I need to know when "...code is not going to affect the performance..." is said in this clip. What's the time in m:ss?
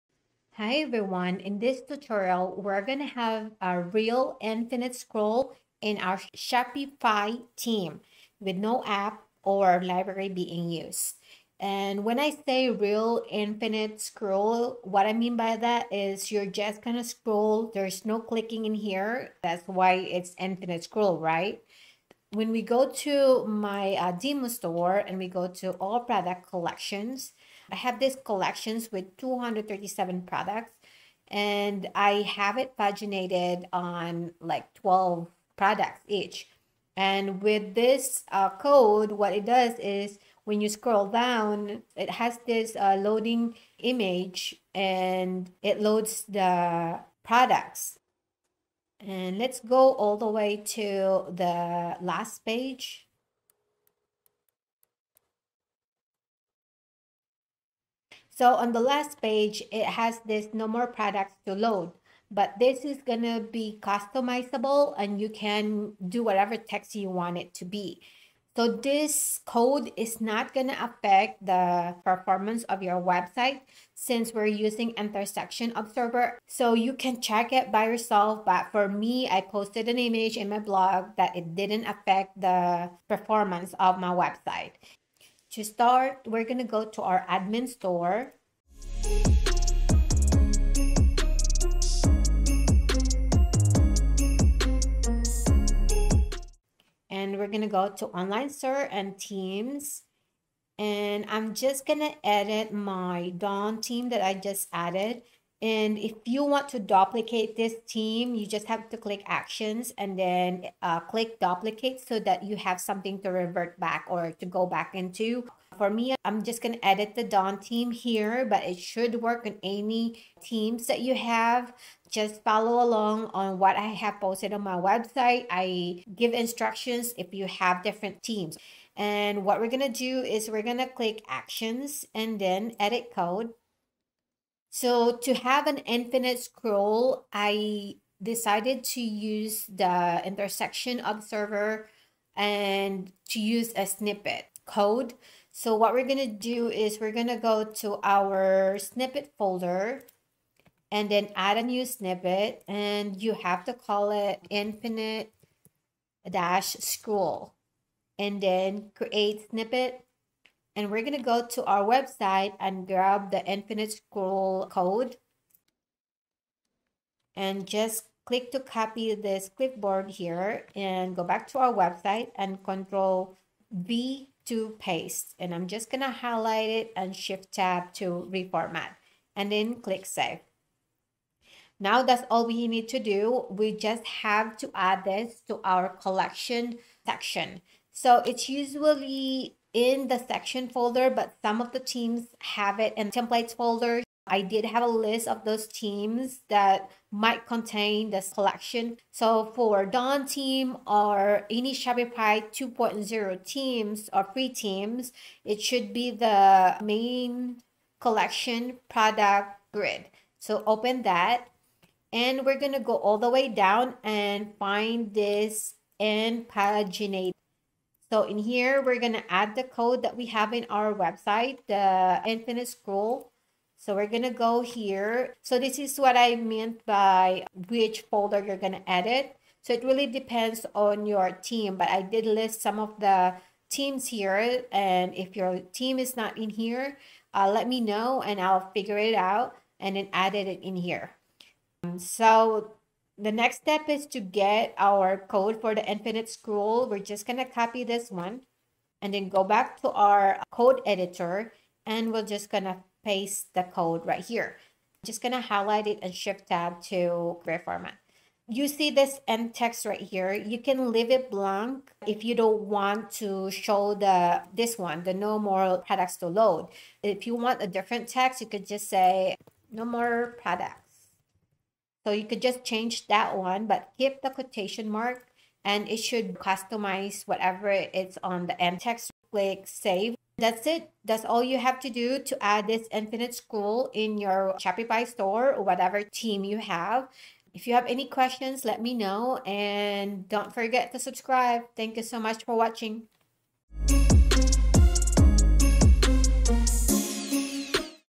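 1:09.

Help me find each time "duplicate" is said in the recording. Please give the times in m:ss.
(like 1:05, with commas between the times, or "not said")
1:46, 1:51.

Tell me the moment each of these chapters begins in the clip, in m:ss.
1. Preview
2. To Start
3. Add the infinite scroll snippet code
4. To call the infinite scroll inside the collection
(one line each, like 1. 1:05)
1. 0:10
2. 1:27
3. 2:14
4. 3:01.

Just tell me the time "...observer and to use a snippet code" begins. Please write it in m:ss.
2:21.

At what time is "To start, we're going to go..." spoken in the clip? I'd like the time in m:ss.
1:25.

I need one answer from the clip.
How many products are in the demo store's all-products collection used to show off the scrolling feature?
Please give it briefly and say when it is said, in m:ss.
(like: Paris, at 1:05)
237, at 0:29.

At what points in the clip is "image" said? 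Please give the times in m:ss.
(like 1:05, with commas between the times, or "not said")
0:43, 1:19.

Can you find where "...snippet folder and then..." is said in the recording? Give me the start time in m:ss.
2:28.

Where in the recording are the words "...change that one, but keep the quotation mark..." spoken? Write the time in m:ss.
4:32.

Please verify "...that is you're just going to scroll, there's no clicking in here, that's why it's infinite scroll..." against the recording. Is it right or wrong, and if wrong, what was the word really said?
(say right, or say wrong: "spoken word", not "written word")
right.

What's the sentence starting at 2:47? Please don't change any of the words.
And just click to copy this clipboard here and go back to our website and control V to paste.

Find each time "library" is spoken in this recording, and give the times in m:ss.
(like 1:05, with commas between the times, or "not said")
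0:09.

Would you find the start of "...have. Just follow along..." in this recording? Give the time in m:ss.
2:01.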